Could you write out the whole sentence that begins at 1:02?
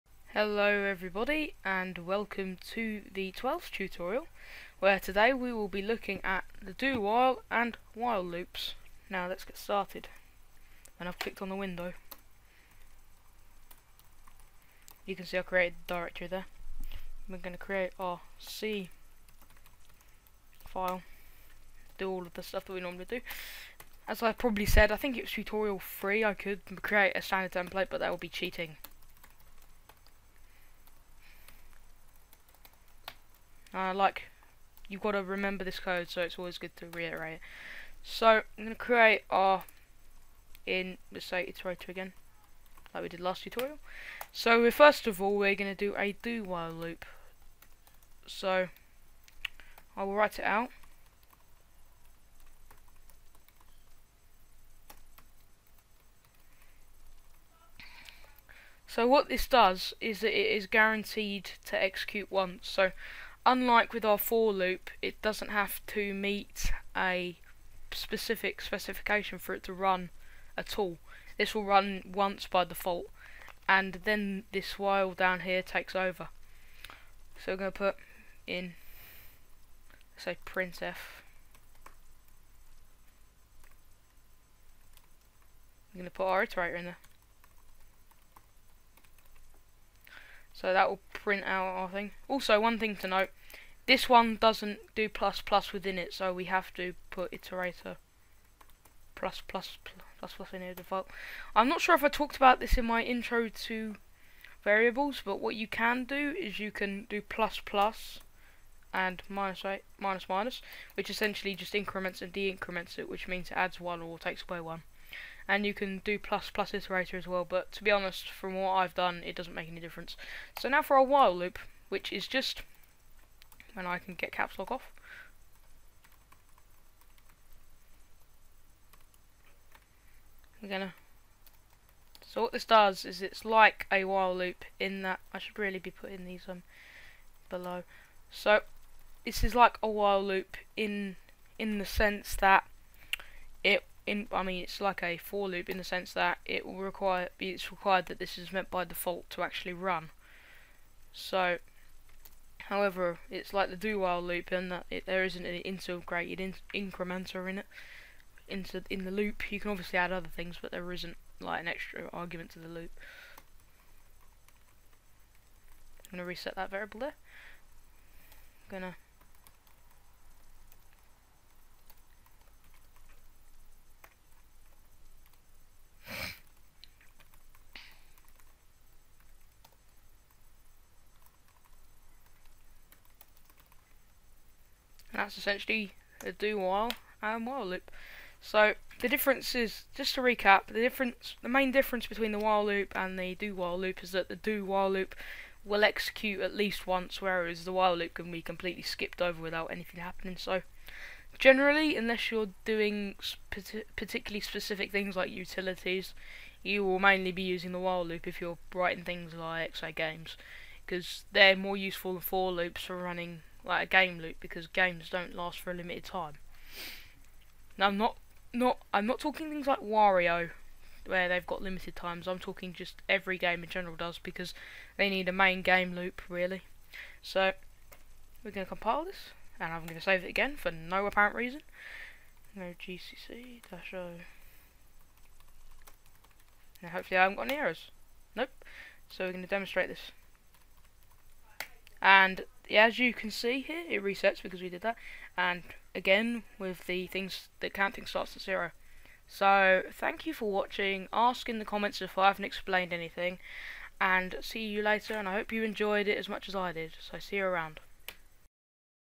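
So unlike with our for loop, it doesn't have to meet a specific specification for it to run at all.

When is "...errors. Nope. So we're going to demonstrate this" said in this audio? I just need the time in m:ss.
3:57.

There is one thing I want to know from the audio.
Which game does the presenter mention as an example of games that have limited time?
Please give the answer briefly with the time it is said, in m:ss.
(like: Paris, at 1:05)
Wario, at 3:39.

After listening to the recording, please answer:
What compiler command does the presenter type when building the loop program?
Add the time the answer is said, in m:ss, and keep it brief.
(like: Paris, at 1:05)
GCC, at 3:52.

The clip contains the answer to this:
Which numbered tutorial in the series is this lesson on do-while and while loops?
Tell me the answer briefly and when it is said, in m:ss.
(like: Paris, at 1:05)
12th, at 0:03.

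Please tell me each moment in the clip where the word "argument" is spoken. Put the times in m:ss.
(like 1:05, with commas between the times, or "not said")
2:42.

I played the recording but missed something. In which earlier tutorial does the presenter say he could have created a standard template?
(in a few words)
3.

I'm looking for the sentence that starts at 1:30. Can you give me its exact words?
So that will print out our thing.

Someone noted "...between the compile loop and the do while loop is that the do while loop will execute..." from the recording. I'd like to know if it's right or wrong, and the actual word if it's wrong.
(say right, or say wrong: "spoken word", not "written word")
wrong: "while", not "compile".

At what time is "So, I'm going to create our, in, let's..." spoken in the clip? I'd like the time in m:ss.
0:38.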